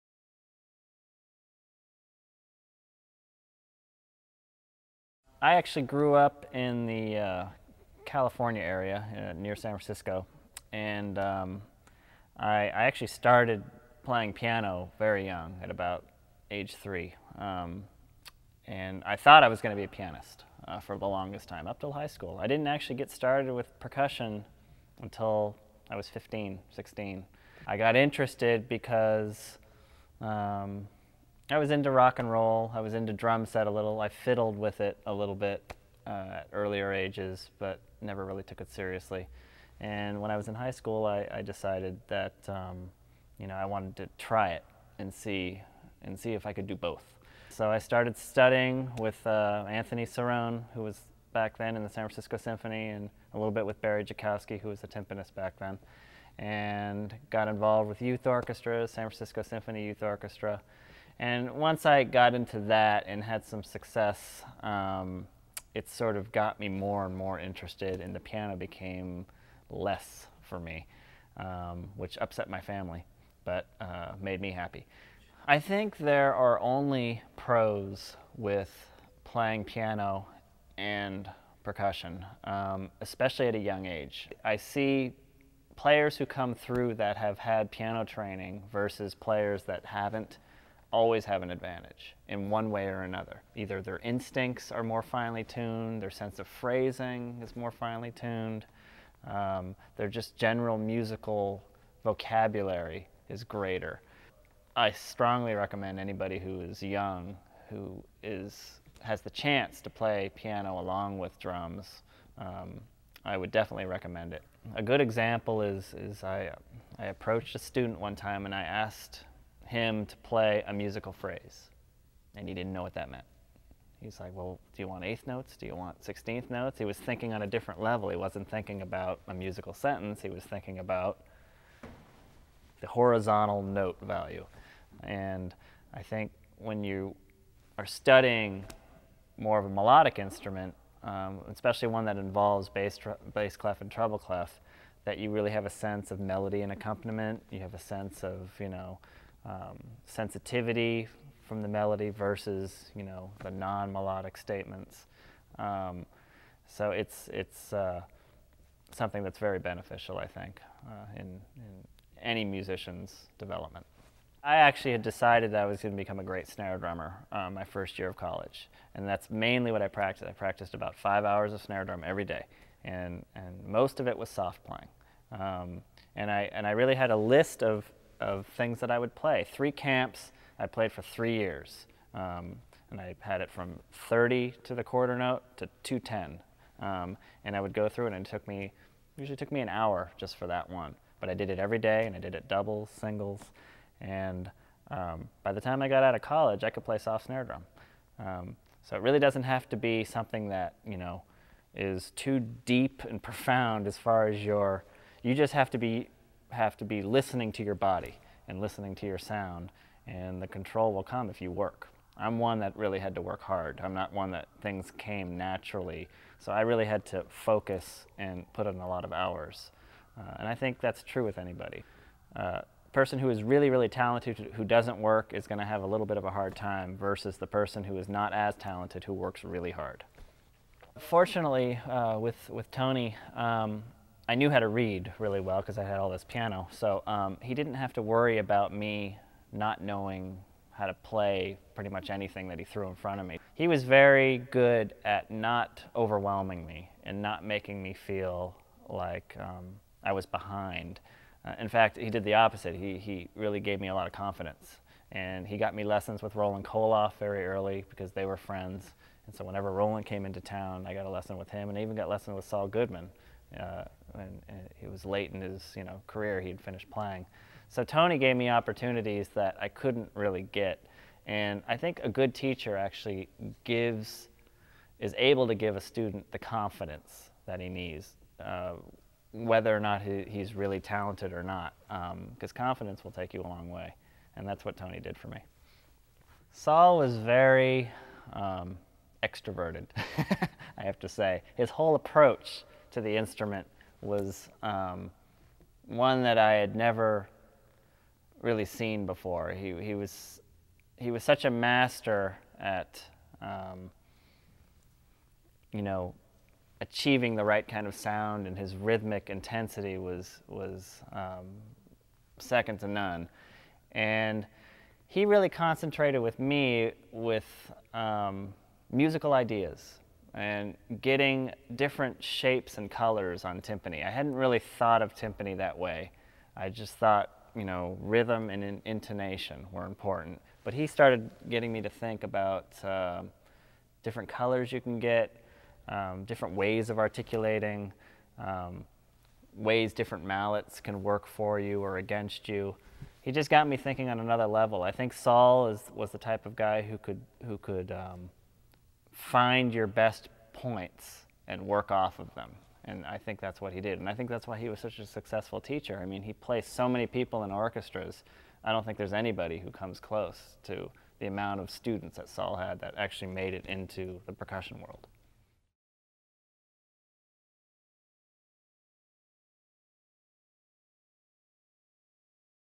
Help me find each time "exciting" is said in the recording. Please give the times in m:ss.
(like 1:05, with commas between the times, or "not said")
not said.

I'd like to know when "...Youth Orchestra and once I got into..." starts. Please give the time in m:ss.
0:59.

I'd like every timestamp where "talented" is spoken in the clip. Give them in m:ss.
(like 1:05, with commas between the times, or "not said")
3:43, 3:48, 4:40.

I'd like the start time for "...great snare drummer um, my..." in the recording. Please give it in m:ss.
2:46.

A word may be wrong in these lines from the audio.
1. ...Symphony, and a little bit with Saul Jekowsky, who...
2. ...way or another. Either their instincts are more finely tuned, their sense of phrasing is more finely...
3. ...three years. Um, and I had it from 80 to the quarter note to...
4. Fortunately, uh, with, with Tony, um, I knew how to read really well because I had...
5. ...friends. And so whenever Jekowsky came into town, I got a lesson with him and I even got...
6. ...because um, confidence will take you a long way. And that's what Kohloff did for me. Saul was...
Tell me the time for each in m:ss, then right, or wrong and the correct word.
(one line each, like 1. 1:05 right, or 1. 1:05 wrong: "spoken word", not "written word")
1. 0:52 wrong: "Barry", not "Saul"
2. 1:32 right
3. 3:01 wrong: "30", not "80"
4. 3:50 right
5. 4:18 wrong: "Roland", not "Jekowsky"
6. 4:41 wrong: "Tony", not "Kohloff".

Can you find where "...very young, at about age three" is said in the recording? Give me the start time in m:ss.
0:14.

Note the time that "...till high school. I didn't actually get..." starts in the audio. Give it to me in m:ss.
0:21.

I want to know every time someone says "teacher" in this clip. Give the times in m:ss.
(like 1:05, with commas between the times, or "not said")
4:32, 5:55.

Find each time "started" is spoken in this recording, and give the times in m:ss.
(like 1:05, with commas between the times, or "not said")
0:13, 0:23, 0:47, 5:30.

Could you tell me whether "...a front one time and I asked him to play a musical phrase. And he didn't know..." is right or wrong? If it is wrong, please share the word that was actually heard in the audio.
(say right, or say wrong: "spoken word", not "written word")
wrong: "student", not "front".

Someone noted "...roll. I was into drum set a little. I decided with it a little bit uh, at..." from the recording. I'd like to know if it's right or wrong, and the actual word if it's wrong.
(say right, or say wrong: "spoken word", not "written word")
wrong: "fiddled", not "decided".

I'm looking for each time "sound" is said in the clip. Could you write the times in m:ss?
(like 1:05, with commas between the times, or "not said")
3:29, 5:07.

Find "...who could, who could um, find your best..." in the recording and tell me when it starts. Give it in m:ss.
5:46.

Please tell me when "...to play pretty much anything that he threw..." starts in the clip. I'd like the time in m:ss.
4:00.